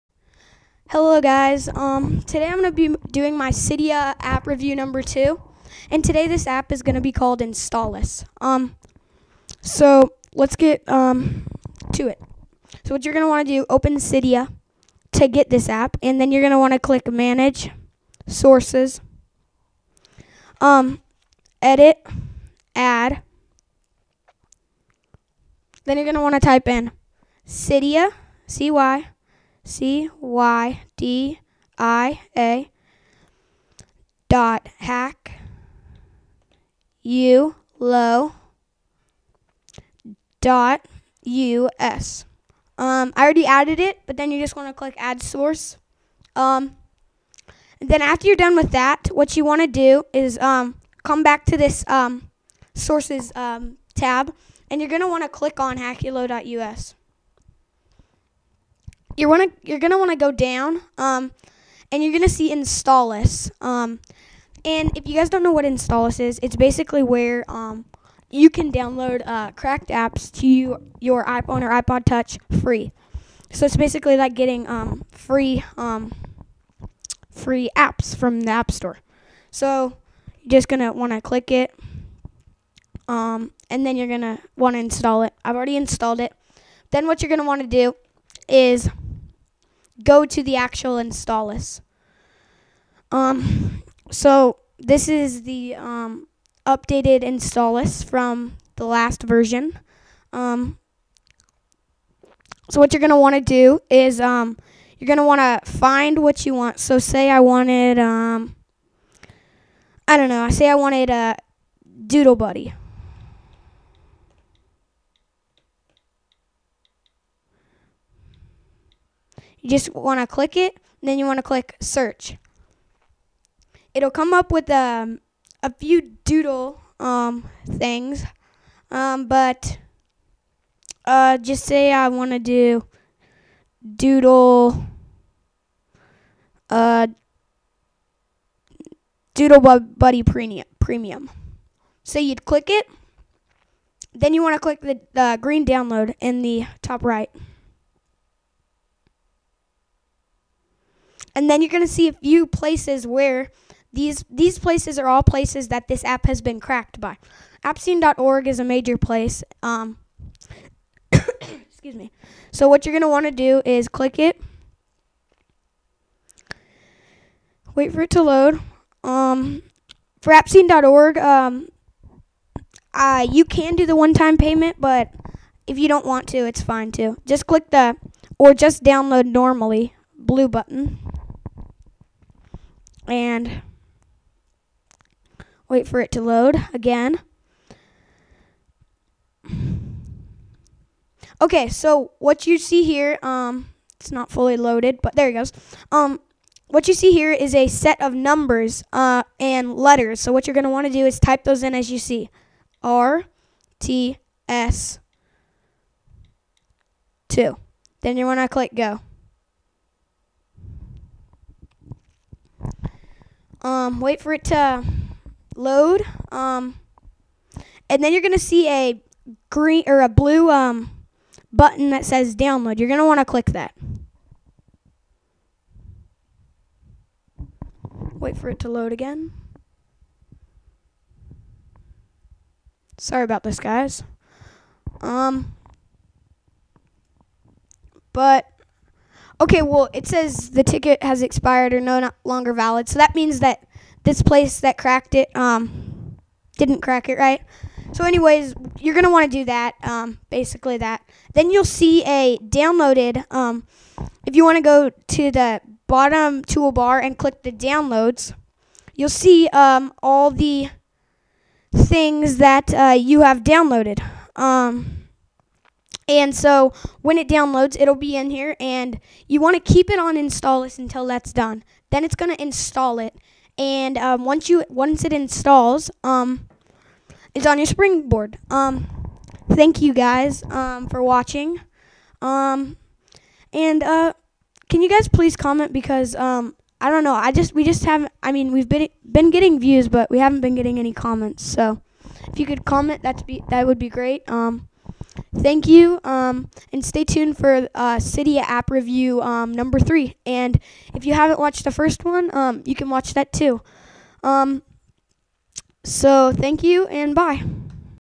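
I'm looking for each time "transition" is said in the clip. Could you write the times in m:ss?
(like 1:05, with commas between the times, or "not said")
not said.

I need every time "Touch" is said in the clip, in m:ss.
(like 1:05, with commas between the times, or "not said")
1:12.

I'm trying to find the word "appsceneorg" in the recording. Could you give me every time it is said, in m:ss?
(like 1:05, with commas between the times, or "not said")
2:37, 2:50.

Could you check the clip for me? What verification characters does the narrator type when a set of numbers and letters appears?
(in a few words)
RTS2.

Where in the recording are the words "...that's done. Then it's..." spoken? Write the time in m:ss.
4:31.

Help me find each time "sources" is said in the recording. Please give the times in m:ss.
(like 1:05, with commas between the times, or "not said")
0:18, 0:45, 0:52.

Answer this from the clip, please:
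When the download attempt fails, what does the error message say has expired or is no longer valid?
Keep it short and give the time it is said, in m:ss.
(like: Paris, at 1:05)
the ticket, at 4:00.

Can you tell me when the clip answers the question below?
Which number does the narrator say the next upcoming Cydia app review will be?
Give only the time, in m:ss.
4:59.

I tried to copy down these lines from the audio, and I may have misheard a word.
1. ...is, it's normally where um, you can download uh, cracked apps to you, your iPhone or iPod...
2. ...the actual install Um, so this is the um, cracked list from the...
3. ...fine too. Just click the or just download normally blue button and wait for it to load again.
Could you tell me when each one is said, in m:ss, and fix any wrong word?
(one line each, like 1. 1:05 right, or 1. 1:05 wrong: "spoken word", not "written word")
1. 1:06 wrong: "basically", not "normally"
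2. 1:30 wrong: "updated", not "cracked"
3. 2:56 right.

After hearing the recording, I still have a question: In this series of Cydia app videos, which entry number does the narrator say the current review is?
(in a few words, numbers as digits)
2.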